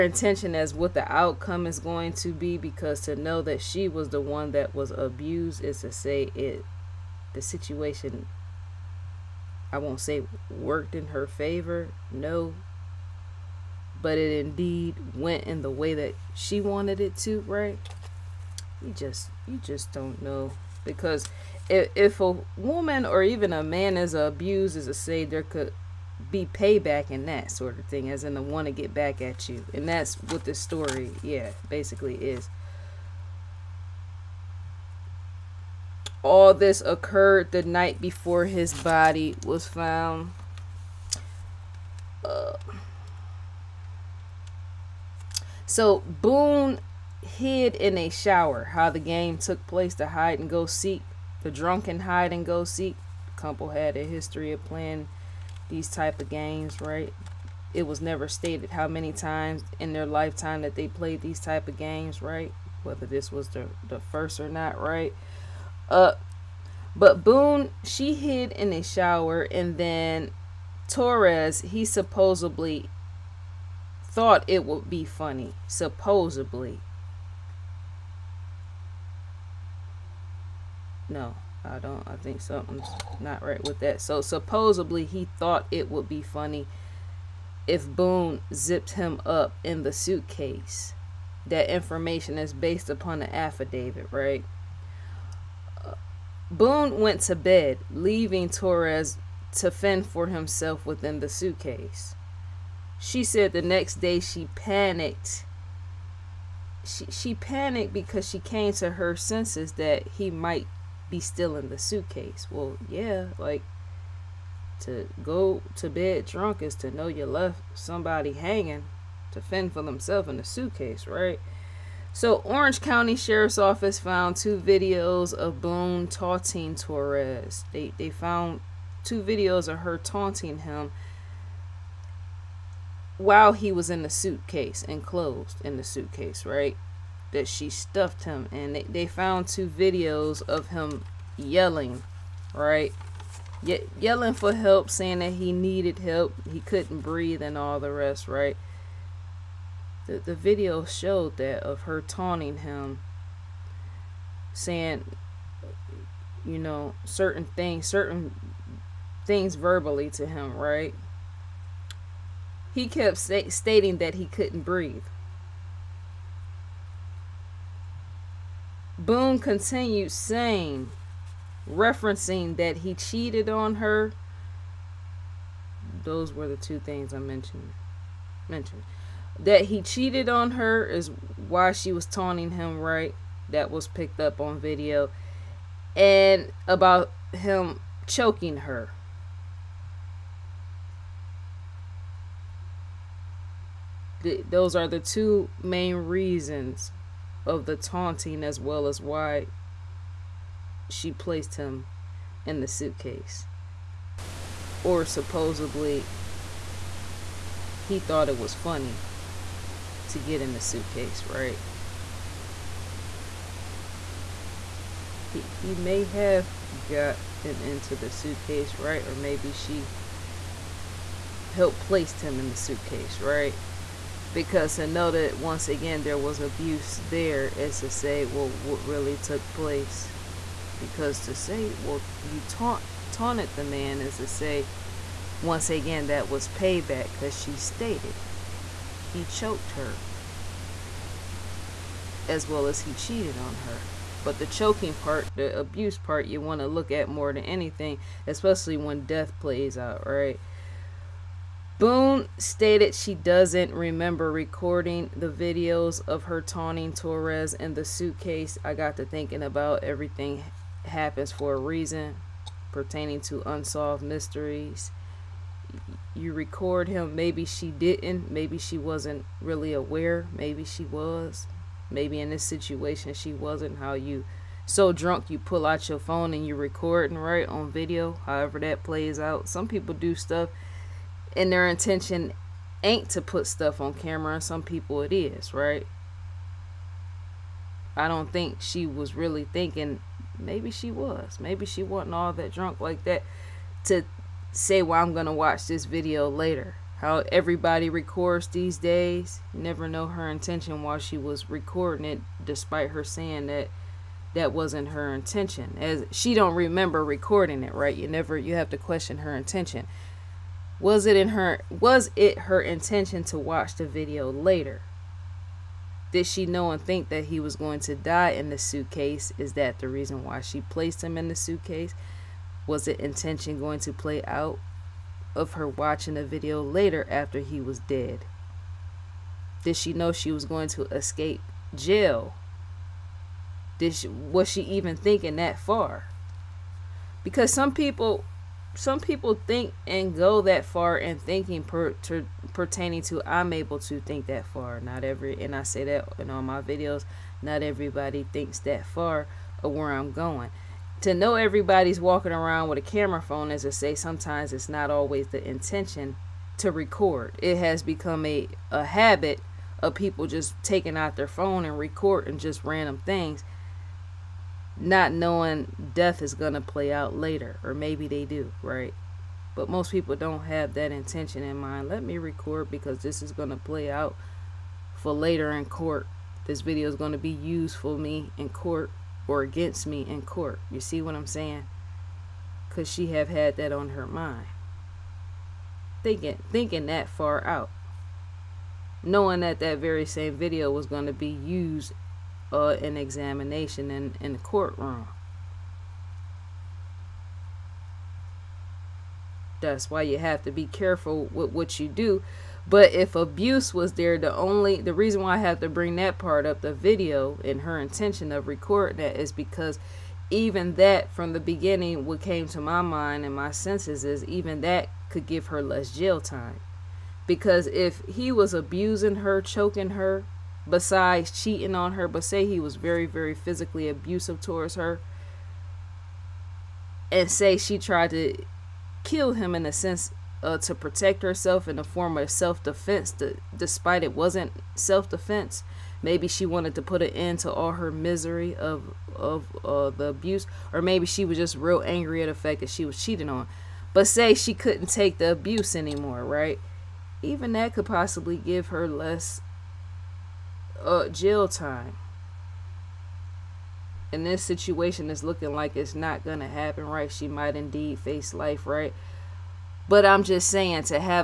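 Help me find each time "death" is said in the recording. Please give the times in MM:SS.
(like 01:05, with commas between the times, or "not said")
04:09, 06:05.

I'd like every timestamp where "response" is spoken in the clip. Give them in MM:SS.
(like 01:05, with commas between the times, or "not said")
not said.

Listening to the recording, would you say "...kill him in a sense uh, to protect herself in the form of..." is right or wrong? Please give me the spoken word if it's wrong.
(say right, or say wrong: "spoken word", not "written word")
right.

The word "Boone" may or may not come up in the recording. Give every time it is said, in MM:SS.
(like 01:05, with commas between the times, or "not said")
00:46, 01:07, 01:27, 01:36, 02:05, 02:49, 04:11.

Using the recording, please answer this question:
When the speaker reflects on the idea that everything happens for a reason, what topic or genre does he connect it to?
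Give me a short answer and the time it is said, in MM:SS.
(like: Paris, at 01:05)
Unsolved mysteries, at 04:23.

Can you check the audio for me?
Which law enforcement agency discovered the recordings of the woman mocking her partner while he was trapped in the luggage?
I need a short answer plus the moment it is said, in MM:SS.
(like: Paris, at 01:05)
Orange County Sheriff's Office, at 02:02.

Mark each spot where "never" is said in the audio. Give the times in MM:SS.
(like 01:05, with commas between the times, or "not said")
00:58, 04:59, 05:08.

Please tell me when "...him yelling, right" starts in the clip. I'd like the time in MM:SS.
02:20.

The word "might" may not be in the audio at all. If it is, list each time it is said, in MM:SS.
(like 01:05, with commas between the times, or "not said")
01:50, 07:37.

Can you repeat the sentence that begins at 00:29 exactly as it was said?
And that's what the story, yeah, basically is.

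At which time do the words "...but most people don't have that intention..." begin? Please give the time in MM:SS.
06:09.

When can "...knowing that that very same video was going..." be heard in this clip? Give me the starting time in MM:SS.
06:29.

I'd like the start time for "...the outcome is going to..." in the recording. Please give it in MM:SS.
00:00.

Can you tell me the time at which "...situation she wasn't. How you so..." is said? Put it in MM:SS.
04:32.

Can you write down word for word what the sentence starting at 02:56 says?
Those were the two things I mentioned.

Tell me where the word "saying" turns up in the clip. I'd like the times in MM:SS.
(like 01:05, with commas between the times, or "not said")
02:24, 02:34, 02:50, 05:03, 06:21, 07:40.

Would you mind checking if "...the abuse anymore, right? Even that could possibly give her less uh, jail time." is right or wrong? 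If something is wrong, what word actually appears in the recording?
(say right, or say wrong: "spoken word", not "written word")
right.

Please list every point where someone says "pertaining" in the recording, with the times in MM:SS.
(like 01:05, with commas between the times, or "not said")
04:22, 05:42.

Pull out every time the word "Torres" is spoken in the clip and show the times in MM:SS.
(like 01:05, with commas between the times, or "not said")
01:10, 01:38, 02:06, 04:16.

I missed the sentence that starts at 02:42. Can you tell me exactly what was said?
He kept st- stating that he couldn't breathe.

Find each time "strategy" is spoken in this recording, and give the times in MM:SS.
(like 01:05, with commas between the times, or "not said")
not said.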